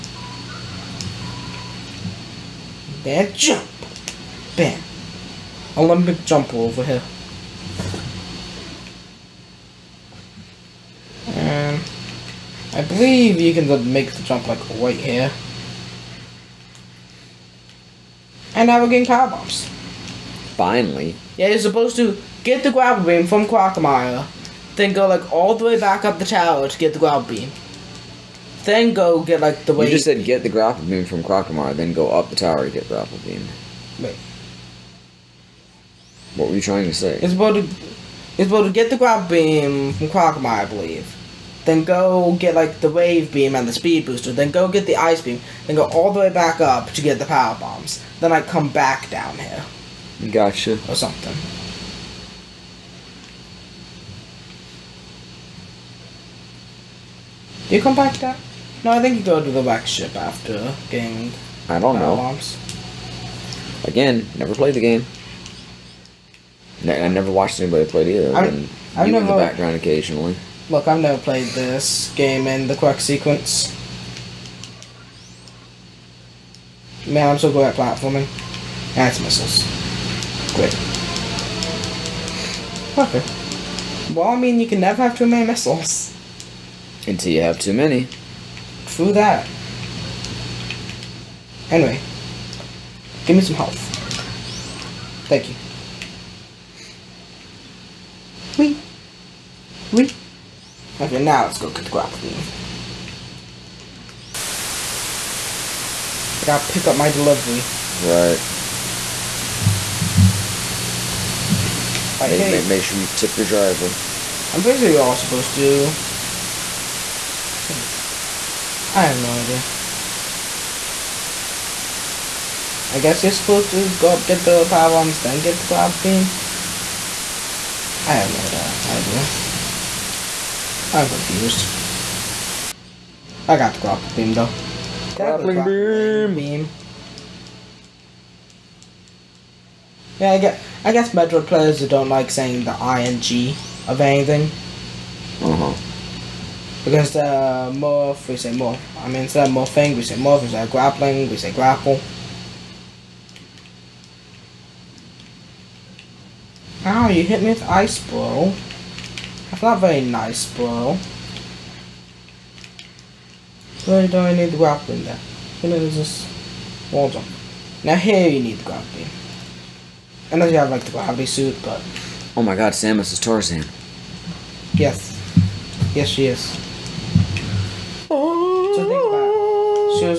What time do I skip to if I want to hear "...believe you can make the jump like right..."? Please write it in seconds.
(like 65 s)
12 s.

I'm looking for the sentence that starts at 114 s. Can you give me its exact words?
I'm pretty sure you're all supposed to.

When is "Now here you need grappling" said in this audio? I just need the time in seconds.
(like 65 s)
167 s.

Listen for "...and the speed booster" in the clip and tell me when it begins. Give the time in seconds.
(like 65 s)
43 s.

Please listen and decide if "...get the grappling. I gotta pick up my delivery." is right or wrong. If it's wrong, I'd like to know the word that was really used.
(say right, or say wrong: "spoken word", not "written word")
right.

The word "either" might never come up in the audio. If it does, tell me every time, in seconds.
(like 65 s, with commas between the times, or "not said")
68 s.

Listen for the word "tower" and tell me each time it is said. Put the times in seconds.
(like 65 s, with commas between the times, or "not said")
26 s, 32 s.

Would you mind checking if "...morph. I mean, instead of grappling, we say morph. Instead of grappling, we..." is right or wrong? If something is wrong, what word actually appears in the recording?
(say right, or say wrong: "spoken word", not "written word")
wrong: "morphing", not "grappling".